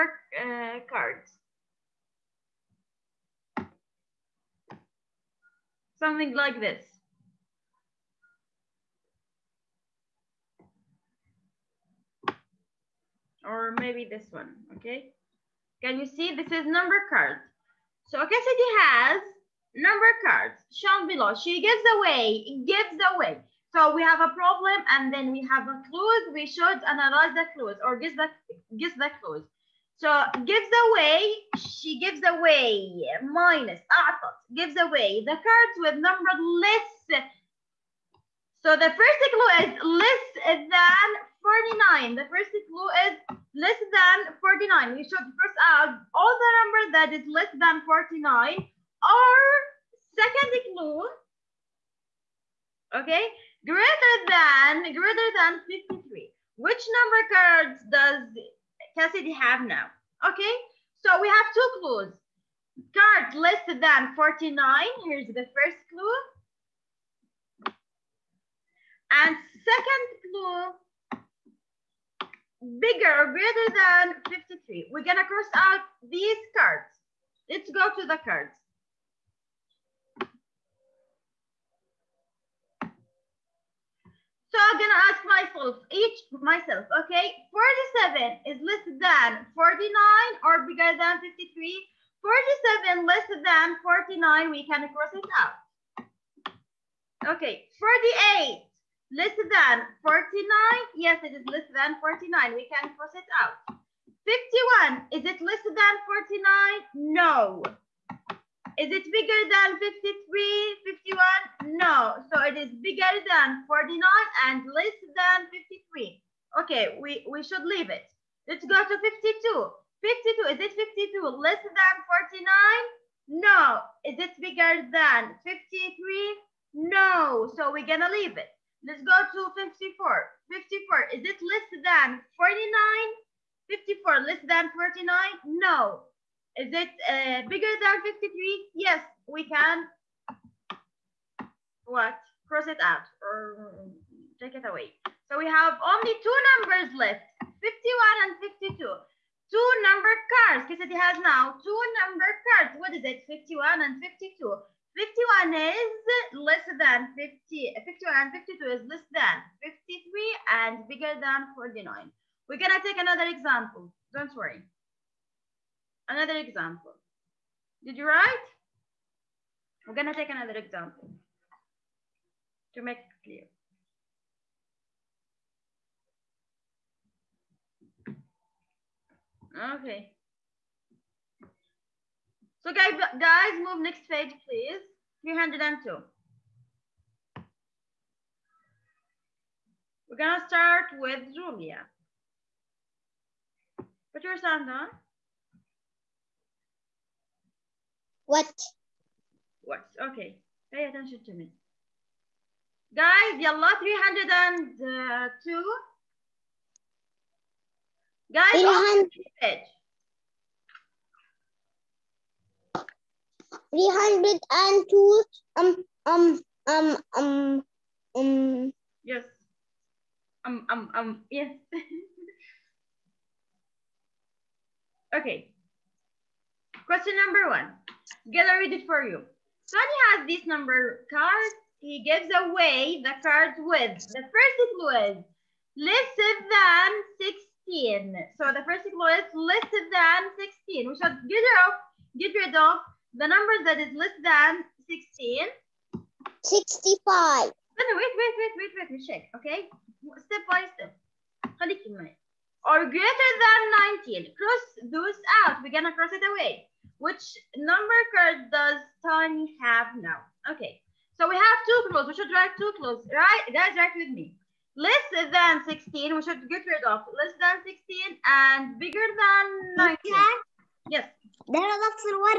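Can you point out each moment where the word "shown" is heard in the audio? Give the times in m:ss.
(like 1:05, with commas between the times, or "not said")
0:20.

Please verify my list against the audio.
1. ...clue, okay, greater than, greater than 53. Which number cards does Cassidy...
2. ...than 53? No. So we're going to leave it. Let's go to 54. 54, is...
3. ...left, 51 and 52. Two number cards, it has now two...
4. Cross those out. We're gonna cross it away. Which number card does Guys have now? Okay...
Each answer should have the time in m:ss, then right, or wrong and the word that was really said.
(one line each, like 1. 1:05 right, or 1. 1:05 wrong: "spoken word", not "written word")
1. 0:50 right
2. 2:04 right
3. 2:26 right
4. 4:14 wrong: "Tony", not "Guys".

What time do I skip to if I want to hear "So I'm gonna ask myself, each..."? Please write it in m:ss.
1:24.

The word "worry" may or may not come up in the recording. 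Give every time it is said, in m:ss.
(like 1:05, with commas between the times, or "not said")
2:44.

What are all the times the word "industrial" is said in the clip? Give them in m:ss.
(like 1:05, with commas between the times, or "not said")
not said.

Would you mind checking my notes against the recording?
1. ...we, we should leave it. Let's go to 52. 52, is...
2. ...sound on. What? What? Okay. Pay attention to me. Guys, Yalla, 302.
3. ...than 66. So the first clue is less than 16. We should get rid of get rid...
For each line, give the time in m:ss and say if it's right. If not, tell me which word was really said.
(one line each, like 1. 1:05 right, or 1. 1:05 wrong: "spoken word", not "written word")
1. 1:57 right
2. 3:14 right
3. 3:56 wrong: "16", not "66".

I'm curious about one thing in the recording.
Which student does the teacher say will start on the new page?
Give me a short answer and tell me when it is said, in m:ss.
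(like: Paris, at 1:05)
Julia, at 3:11.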